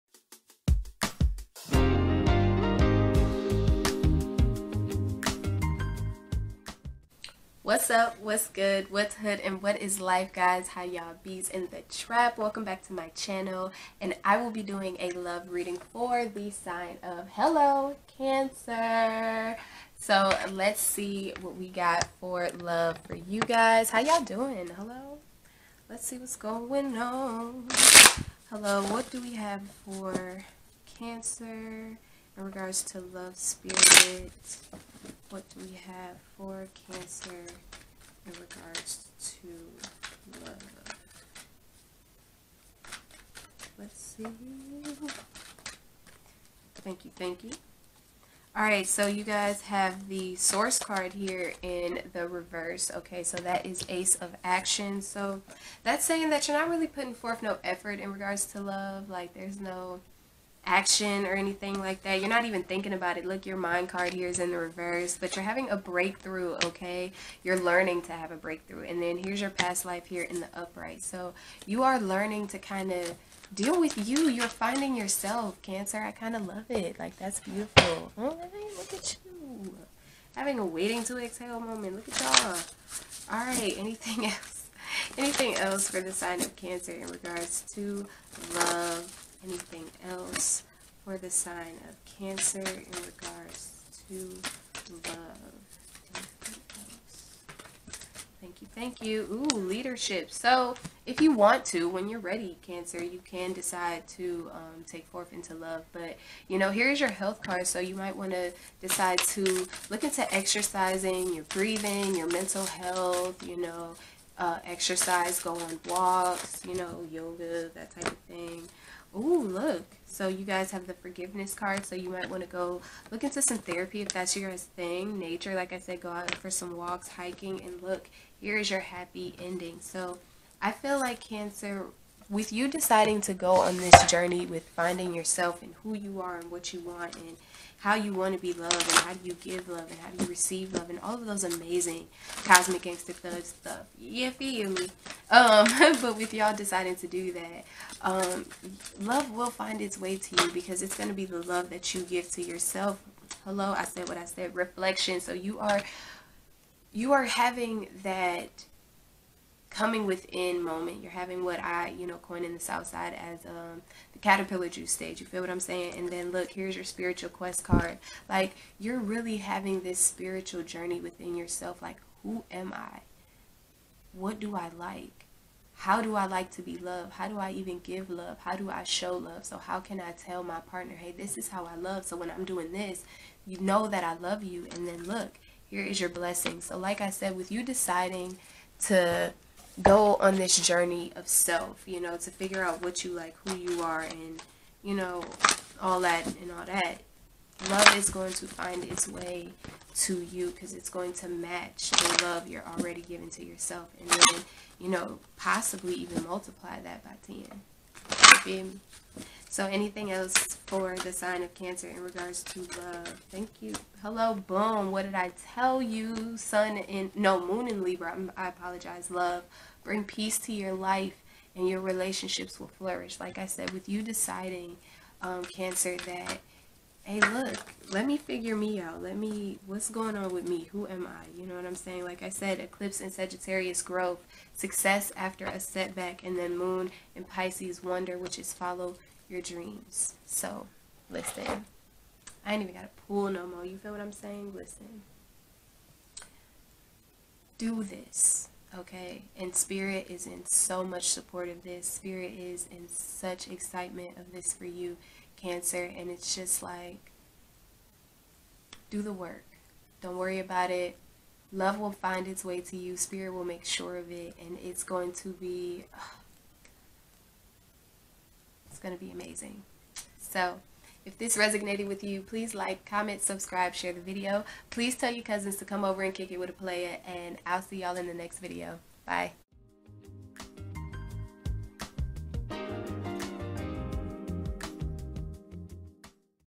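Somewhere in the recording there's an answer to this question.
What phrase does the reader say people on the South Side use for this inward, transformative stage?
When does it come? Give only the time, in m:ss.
2:44.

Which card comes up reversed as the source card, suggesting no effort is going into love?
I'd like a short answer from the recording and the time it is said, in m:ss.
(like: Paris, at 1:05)
Ace of Action, at 0:53.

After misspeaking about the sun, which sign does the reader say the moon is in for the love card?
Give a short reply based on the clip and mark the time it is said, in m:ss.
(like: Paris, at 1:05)
Libra, at 3:37.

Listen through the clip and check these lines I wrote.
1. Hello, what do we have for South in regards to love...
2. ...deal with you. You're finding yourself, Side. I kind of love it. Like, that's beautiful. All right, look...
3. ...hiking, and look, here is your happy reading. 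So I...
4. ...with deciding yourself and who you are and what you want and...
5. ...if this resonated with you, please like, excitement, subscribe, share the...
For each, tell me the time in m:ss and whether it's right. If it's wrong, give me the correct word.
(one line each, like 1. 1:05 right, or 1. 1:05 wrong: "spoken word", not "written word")
1. 0:28 wrong: "Cancer", not "South"
2. 1:13 wrong: "Cancer", not "Side"
3. 2:07 wrong: "ending", not "reading"
4. 2:14 wrong: "finding", not "deciding"
5. 4:31 wrong: "comment", not "excitement".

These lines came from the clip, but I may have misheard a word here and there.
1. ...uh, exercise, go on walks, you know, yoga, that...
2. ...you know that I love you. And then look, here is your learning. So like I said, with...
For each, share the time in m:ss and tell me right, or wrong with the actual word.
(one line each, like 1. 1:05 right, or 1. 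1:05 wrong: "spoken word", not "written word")
1. 1:54 right
2. 3:03 wrong: "blessing", not "learning".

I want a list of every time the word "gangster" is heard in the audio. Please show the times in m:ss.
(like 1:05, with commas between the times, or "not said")
2:22.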